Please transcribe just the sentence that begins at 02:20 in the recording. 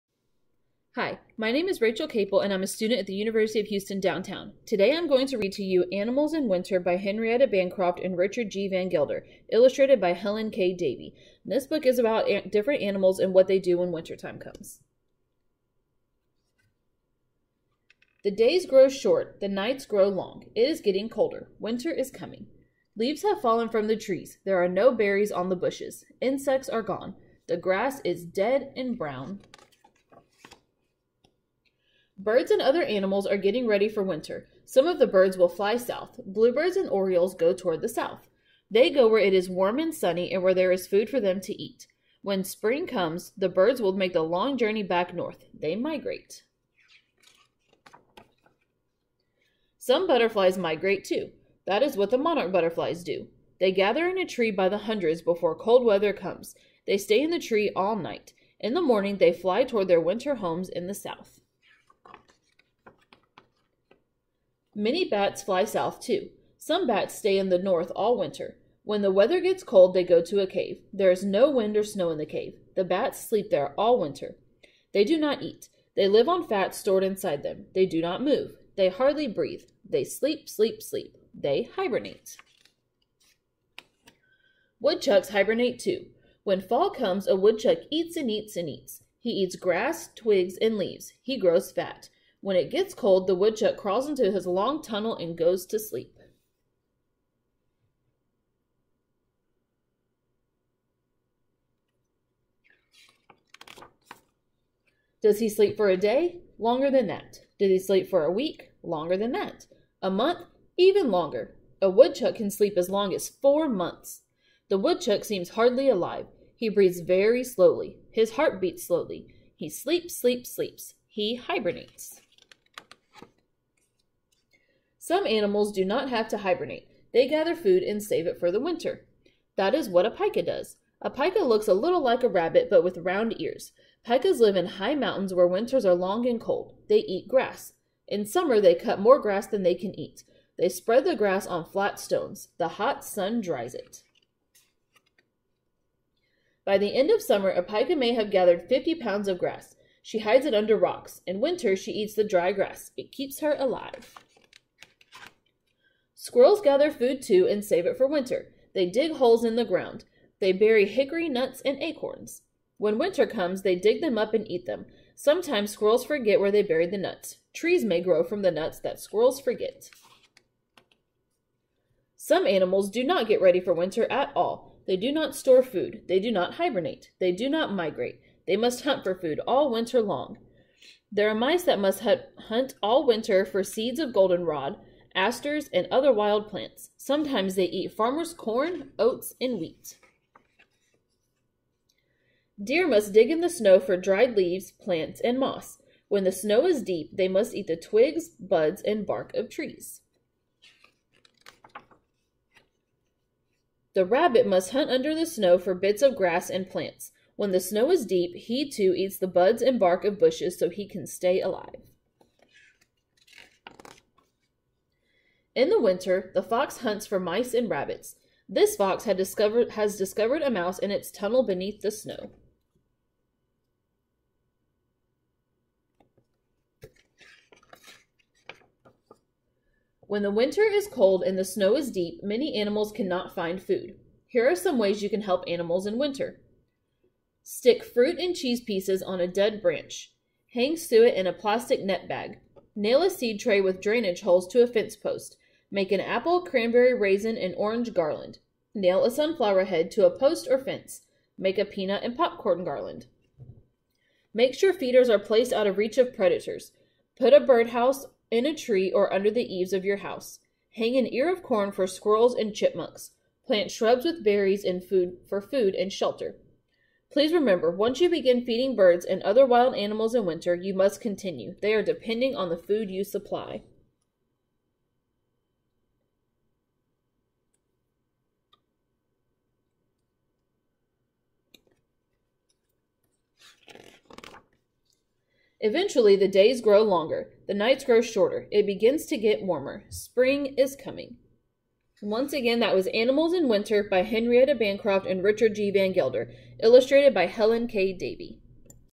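They spread the grass on flat stones.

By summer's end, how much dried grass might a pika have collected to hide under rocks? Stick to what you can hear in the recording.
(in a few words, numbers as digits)
50 pounds.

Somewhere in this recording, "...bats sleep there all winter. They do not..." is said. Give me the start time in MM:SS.
01:12.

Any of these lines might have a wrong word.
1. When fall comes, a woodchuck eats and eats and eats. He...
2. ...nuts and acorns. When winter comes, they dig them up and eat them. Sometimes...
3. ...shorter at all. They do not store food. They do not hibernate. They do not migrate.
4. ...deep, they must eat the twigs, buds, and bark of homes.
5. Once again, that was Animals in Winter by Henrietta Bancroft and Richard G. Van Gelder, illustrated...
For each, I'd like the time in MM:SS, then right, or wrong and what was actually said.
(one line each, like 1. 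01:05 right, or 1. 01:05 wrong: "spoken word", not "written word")
1. 01:26 right
2. 02:41 right
3. 02:53 wrong: "winter", not "shorter"
4. 03:16 wrong: "trees", not "homes"
5. 04:52 right.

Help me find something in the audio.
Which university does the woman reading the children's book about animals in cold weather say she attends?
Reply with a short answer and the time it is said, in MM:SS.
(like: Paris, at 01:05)
University of Houston downtown, at 00:03.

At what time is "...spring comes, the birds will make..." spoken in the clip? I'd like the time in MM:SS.
00:42.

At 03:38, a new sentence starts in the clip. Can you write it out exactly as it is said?
This fox discovered, has discovered a mouse in its tunnel beneath the snow.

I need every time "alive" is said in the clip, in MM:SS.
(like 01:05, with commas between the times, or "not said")
01:55, 02:33, 03:31.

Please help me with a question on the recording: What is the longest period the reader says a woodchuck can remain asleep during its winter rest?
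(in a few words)
4 months.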